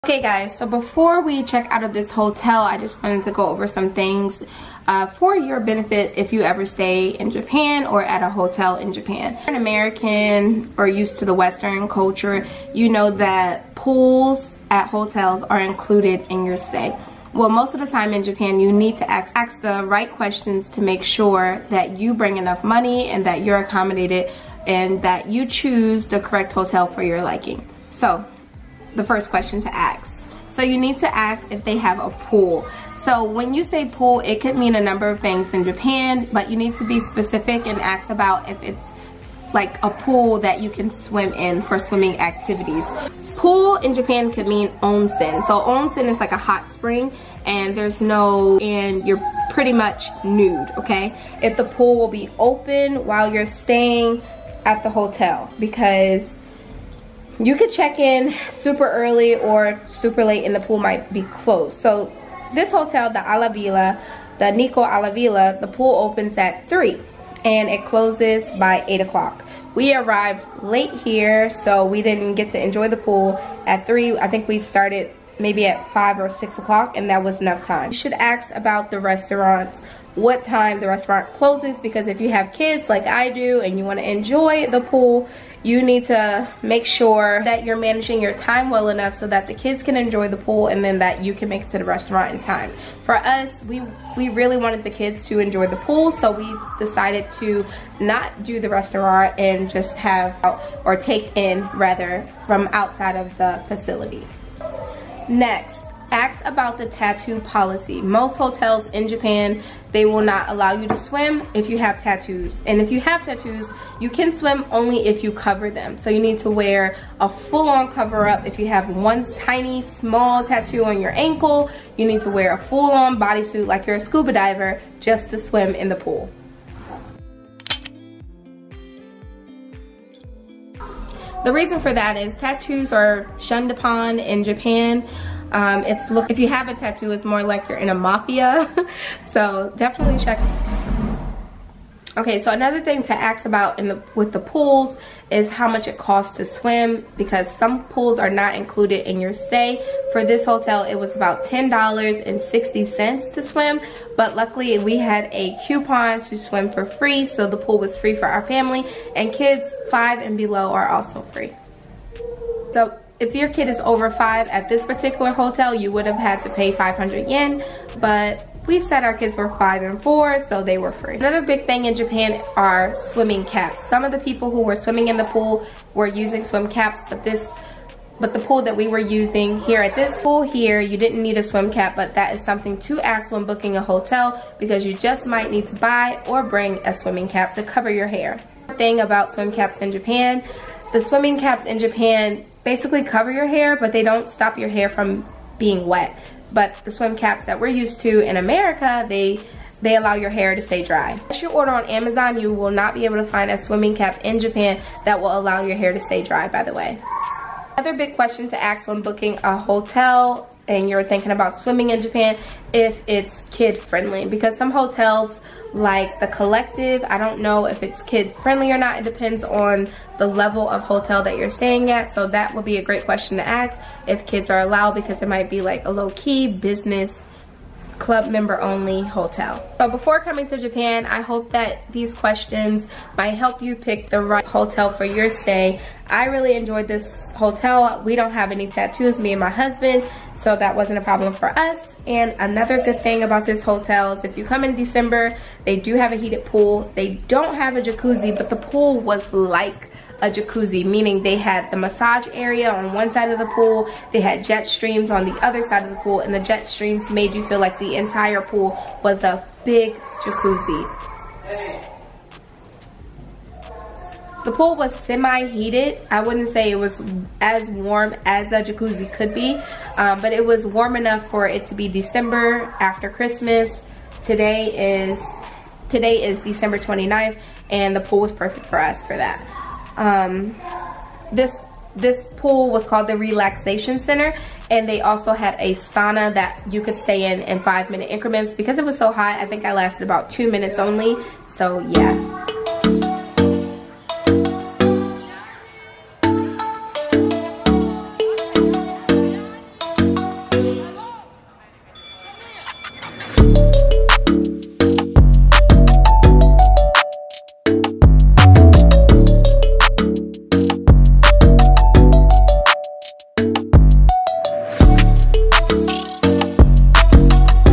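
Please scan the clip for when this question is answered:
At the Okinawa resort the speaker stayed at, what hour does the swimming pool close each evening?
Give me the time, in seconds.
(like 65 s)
68 s.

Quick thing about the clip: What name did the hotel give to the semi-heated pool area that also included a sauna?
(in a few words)
relaxation center.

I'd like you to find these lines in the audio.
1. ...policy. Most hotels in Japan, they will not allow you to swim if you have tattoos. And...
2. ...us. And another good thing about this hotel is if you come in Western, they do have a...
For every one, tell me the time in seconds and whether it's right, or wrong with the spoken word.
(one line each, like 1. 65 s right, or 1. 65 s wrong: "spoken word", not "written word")
1. 107 s right
2. 241 s wrong: "December", not "Western".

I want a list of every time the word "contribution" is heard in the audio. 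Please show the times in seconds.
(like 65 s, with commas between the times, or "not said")
not said.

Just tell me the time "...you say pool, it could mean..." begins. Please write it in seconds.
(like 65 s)
33 s.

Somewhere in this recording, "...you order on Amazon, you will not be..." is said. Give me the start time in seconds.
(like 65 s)
201 s.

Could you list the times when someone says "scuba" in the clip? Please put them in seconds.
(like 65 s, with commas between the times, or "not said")
123 s.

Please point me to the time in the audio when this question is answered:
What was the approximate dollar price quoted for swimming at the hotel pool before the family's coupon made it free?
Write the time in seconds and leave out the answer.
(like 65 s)
151 s.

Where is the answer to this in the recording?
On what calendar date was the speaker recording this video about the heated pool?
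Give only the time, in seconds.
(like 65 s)
276 s.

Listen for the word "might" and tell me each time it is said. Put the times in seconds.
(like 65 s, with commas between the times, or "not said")
60 s, 185 s, 225 s, 233 s.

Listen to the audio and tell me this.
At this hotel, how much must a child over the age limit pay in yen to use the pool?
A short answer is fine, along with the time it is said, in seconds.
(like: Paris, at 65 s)
500 yen, at 166 s.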